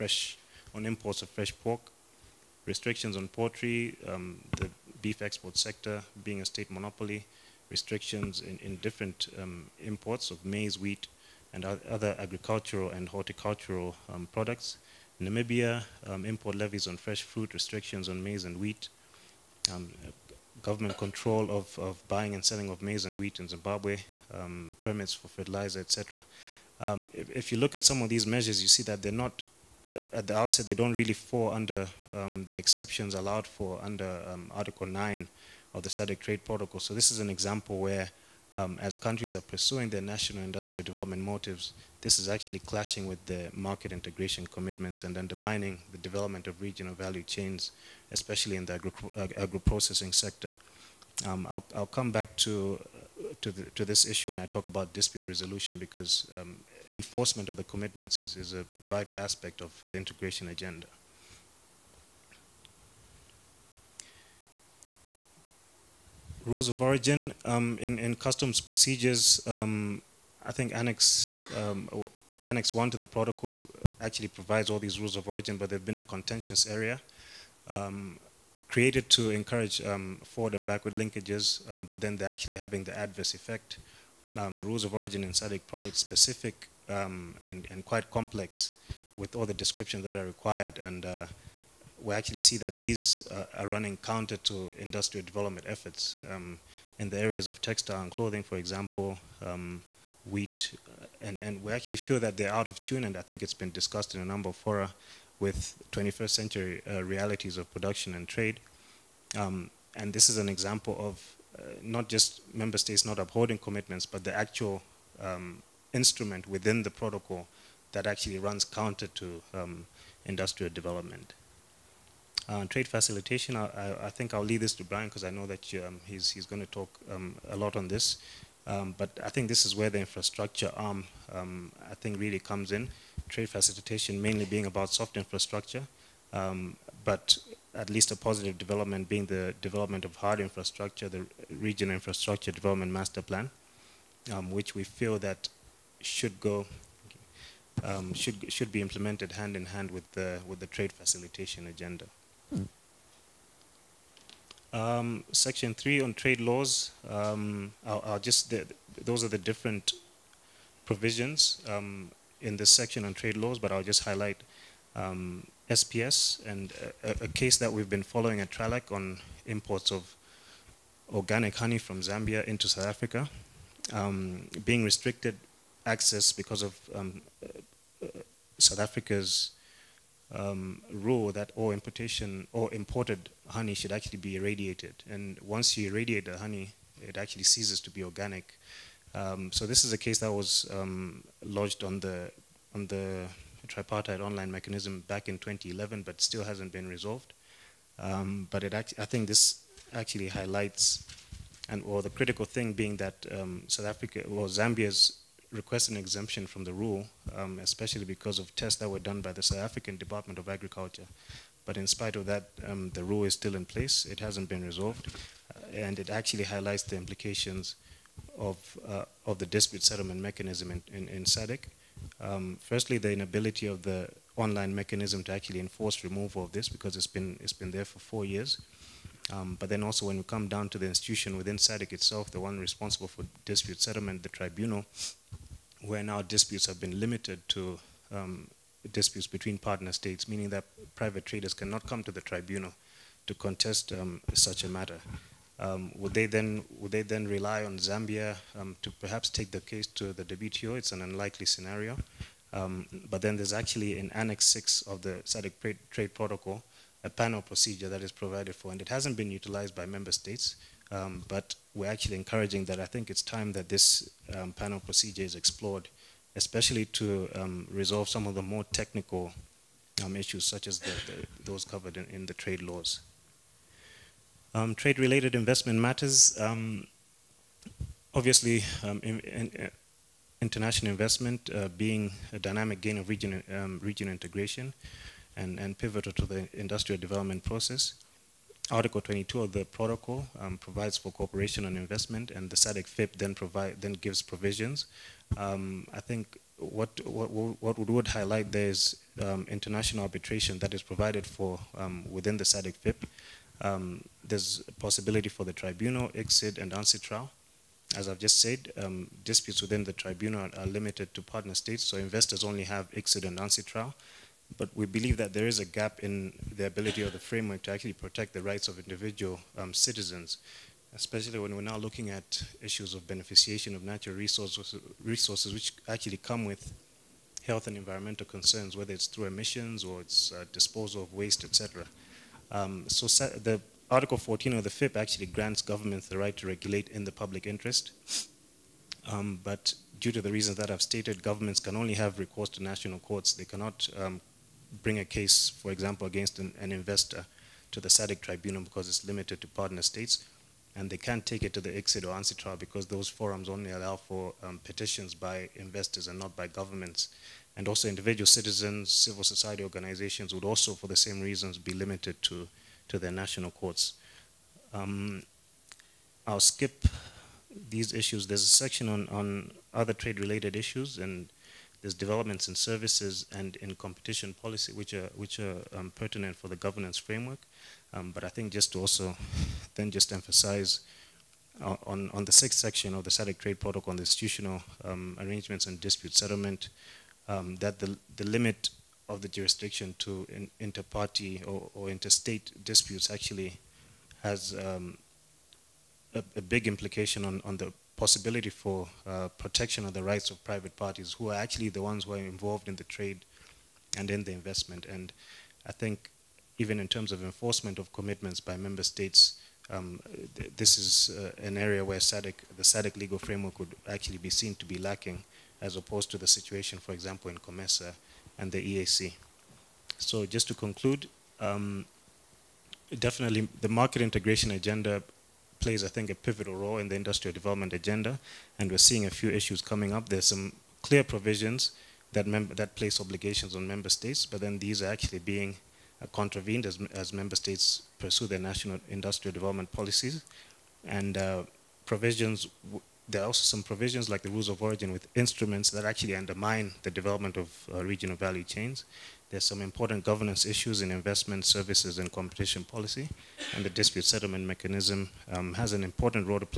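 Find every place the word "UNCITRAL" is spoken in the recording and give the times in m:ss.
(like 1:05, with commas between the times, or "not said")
5:06, 5:13, 5:52.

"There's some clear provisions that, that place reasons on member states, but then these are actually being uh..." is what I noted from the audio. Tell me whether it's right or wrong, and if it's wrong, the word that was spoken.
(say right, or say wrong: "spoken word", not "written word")
wrong: "obligations", not "reasons".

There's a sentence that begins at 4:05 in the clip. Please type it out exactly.
Um, would they then would they then rely on Zambia um, to perhaps take the case to the WTO?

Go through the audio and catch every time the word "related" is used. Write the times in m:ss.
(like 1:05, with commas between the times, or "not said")
4:34, 6:09.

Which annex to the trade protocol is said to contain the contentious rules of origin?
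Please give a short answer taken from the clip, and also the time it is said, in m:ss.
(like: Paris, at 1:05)
Annex One, at 1:12.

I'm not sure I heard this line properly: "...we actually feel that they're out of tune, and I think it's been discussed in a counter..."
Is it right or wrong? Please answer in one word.
wrong.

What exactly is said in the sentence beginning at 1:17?
Um, created to encourage um, forward and backward linkages, um, but then they're actually having the adverse effect.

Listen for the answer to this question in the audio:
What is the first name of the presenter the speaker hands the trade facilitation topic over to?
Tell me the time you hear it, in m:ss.
2:04.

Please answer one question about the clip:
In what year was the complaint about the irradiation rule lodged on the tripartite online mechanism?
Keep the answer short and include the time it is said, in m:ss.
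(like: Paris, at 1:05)
2011, at 3:15.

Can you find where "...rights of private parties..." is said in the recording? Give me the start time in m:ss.
6:40.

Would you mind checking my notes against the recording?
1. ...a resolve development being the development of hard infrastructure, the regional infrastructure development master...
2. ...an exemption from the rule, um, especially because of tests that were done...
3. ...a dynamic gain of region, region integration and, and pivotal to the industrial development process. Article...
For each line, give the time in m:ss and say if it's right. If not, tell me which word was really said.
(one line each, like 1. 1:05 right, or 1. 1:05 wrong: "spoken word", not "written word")
1. 2:18 wrong: "positive", not "resolve"
2. 3:25 right
3. 4:42 right.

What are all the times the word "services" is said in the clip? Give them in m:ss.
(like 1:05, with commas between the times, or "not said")
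6:12, 7:31.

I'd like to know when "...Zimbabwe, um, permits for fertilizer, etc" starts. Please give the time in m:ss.
0:23.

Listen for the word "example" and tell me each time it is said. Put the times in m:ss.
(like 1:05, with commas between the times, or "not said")
0:37, 1:38, 1:50, 5:45, 6:56.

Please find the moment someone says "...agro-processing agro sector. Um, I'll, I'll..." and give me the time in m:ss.
0:49.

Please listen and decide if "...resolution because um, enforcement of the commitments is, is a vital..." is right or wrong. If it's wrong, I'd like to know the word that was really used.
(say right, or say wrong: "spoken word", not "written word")
right.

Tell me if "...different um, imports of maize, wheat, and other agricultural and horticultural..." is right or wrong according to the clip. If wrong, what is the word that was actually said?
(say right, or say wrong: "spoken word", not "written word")
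right.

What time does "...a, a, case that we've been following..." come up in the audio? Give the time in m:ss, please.
2:47.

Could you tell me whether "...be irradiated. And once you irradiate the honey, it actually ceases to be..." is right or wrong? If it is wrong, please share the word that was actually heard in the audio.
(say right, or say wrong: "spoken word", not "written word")
right.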